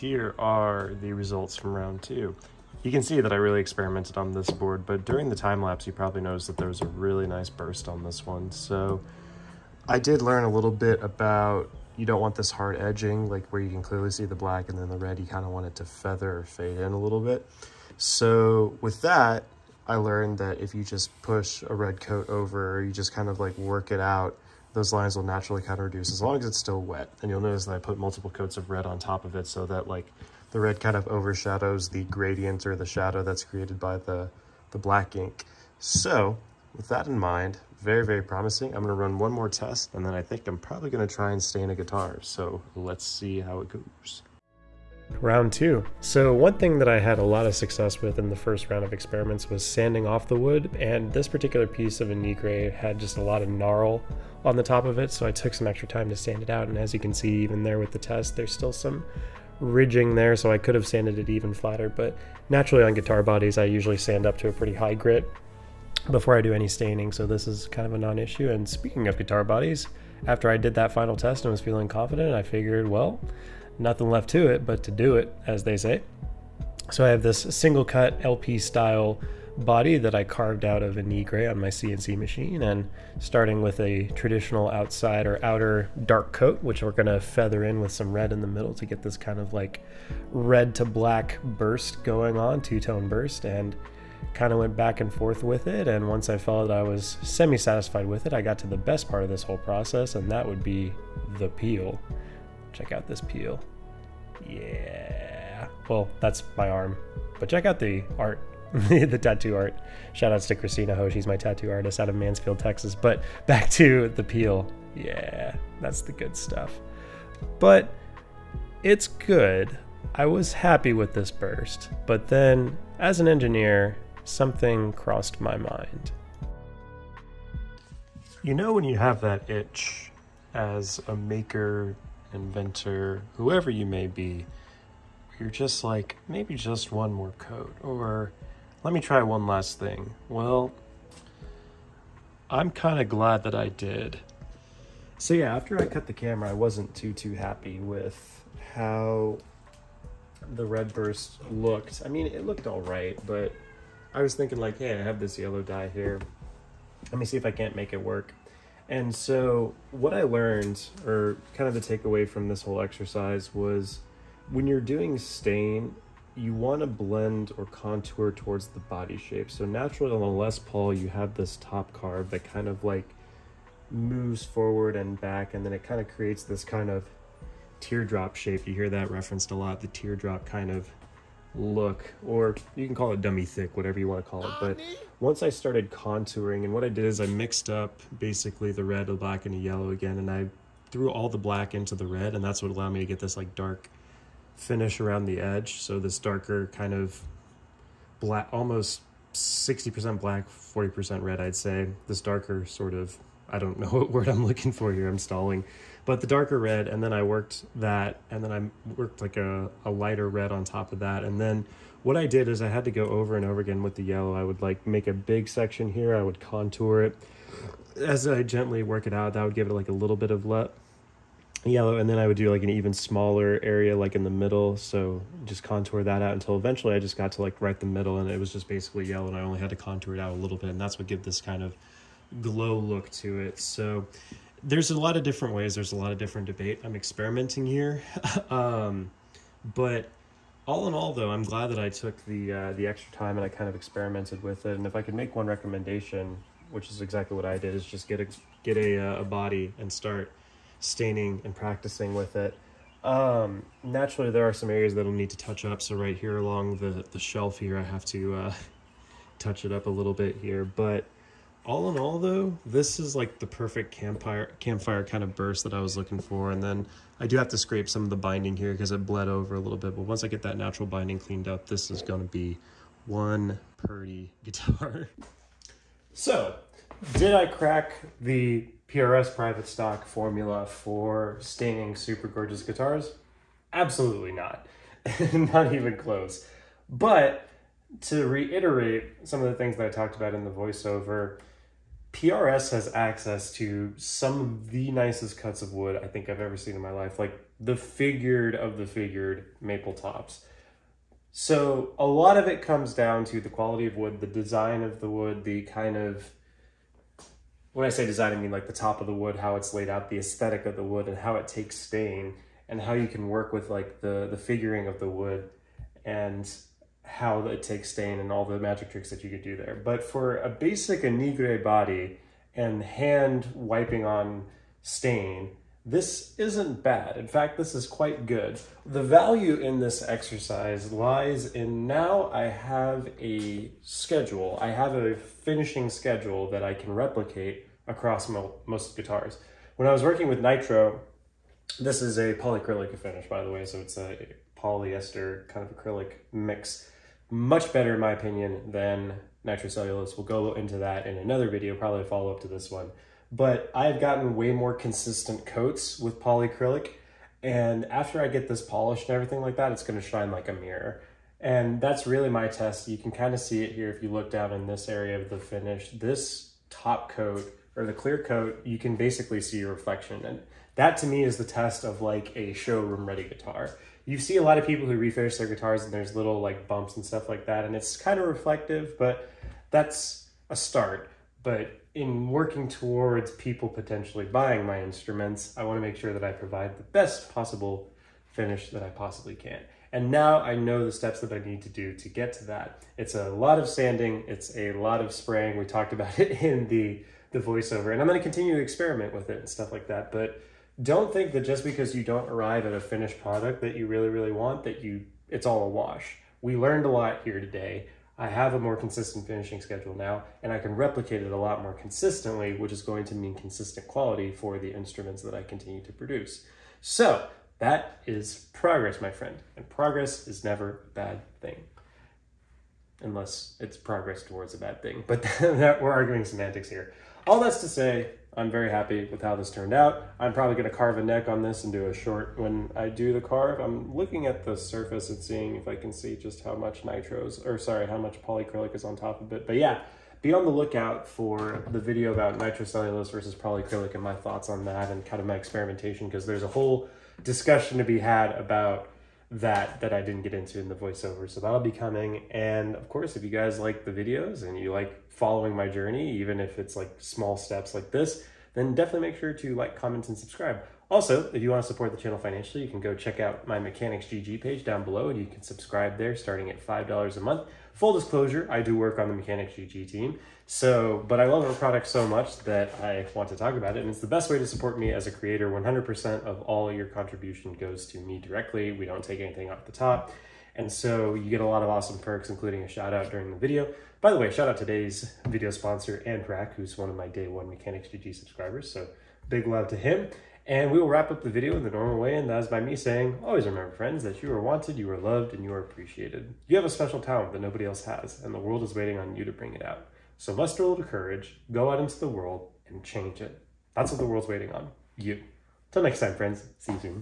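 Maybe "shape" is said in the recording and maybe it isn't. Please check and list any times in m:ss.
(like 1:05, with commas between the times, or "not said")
2:49, 2:58.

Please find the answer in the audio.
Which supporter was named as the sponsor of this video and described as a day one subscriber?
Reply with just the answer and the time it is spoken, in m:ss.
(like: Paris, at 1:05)
Anthrac, at 8:06.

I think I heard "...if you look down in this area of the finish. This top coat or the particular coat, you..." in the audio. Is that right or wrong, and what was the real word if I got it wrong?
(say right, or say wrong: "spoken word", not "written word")
wrong: "clear", not "particular".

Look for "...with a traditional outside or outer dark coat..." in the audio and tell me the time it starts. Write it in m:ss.
1:23.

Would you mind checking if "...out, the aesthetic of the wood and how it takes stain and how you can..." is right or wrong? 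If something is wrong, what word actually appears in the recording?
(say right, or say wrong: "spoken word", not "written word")
right.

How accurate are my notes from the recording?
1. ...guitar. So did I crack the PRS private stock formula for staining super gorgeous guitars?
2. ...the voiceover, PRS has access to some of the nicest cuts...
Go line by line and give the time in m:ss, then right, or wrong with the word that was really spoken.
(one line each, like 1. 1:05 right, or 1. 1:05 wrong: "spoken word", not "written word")
1. 4:34 right
2. 4:50 right.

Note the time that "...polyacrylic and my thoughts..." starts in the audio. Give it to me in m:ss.
7:23.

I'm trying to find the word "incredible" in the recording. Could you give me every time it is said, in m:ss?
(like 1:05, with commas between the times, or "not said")
not said.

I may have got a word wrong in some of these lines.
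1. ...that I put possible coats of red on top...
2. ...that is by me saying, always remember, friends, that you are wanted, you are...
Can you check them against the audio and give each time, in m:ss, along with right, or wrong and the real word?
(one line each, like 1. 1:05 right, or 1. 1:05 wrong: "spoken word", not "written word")
1. 0:27 wrong: "multiple", not "possible"
2. 8:12 right.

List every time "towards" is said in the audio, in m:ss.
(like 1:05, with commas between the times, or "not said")
2:48, 6:22, 7:04.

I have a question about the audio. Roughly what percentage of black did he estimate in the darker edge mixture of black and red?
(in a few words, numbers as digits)
60%.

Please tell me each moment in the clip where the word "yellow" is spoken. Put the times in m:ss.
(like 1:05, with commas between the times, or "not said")
2:35, 3:09, 3:34, 3:41, 3:49.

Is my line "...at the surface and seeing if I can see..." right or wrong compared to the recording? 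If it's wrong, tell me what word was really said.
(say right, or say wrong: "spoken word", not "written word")
right.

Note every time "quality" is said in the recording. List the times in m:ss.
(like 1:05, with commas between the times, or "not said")
5:03, 6:53.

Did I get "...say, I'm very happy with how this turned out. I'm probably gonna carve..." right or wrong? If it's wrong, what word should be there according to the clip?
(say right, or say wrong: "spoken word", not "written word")
right.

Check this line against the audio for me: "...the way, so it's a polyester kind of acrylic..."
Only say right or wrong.
right.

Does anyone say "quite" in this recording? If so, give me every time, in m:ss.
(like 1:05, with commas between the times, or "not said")
5:27.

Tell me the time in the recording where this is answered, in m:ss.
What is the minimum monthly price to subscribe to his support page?
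7:46.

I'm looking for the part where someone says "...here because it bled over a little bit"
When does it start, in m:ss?
4:28.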